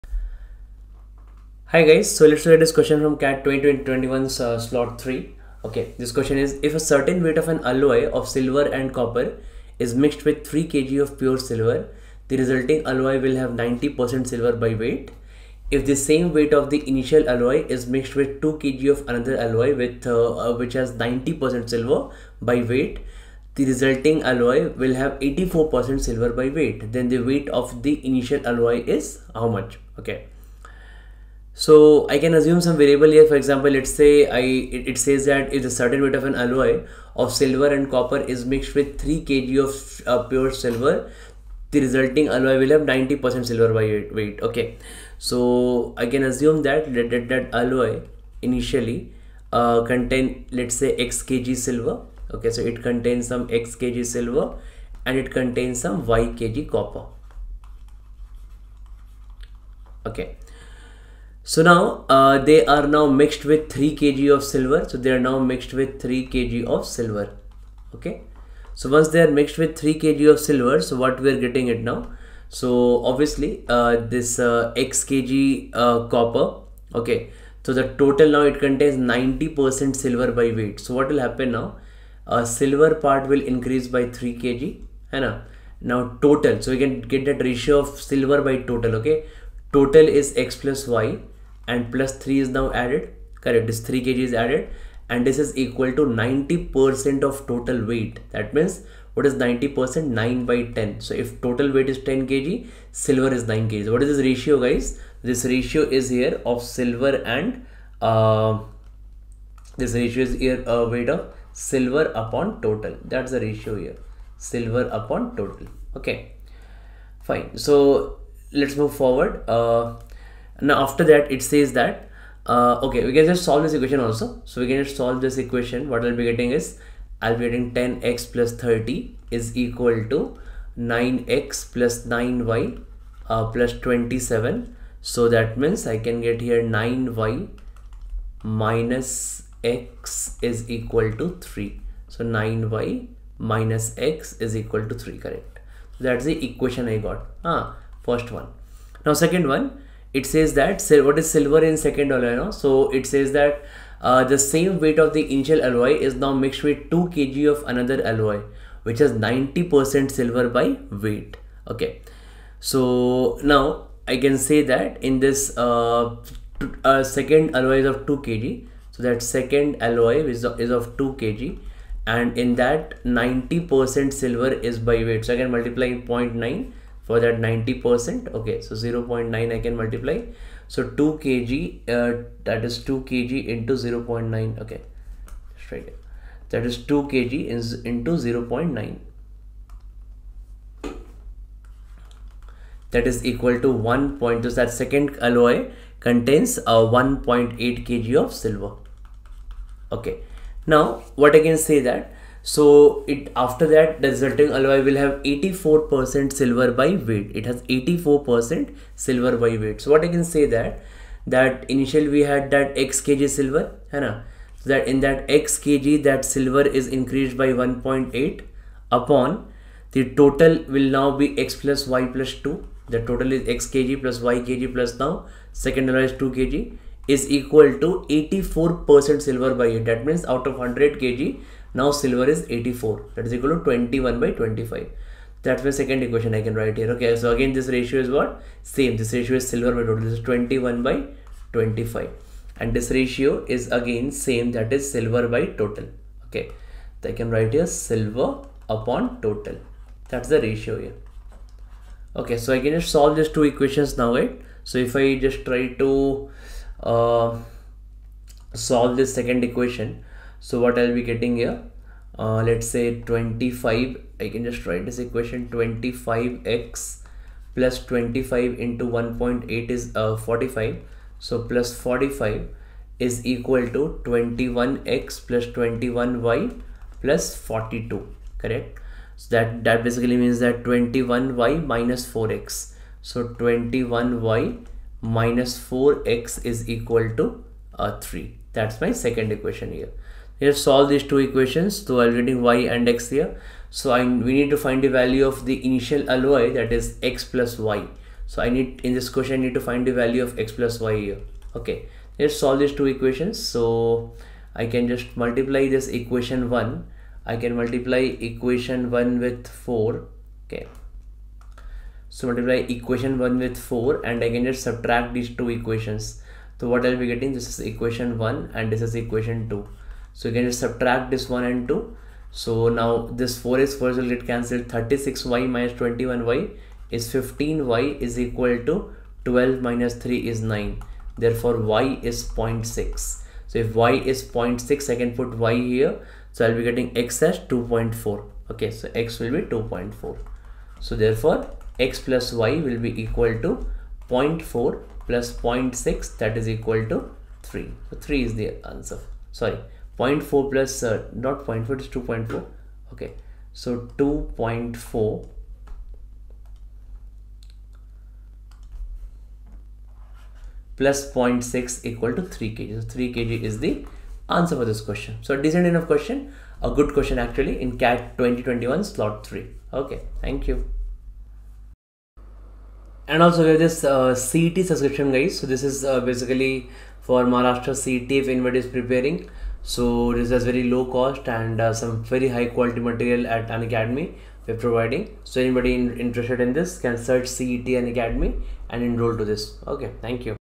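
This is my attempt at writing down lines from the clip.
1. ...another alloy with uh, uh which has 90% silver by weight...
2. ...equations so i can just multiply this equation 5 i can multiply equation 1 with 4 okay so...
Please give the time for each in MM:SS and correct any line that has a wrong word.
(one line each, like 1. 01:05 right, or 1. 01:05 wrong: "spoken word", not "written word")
1. 00:19 right
2. 05:02 wrong: "1", not "5".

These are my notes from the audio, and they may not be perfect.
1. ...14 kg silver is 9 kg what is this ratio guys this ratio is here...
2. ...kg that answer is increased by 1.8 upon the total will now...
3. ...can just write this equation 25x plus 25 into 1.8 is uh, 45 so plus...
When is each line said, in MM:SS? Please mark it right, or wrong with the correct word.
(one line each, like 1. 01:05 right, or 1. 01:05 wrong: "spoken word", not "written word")
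1. 01:42 wrong: "10", not "14"
2. 03:35 wrong: "silver", not "answer"
3. 04:24 right.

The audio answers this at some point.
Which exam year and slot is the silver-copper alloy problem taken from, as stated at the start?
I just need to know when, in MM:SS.
00:03.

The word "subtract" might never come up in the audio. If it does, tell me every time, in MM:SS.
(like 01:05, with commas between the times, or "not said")
05:14, 05:20.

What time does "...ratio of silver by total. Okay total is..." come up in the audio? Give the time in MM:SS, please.
01:27.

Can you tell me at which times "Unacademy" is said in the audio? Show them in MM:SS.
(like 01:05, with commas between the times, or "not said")
06:23, 06:27.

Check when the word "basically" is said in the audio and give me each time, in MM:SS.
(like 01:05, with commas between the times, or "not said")
04:39, 06:16.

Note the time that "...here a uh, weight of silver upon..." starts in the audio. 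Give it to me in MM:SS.
01:50.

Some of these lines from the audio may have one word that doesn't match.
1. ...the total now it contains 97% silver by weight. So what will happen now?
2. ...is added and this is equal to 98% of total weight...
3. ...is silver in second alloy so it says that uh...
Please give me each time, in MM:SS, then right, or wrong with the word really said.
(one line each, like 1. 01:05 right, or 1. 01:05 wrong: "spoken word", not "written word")
1. 01:17 wrong: "90", not "97"
2. 01:34 wrong: "90", not "98"
3. 02:31 right.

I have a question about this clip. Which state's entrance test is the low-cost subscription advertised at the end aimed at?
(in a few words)
Maharashtra.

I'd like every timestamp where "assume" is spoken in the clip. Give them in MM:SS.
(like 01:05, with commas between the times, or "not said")
00:32, 00:46.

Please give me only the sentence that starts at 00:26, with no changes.
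Then the weight of the initial alloy is how much?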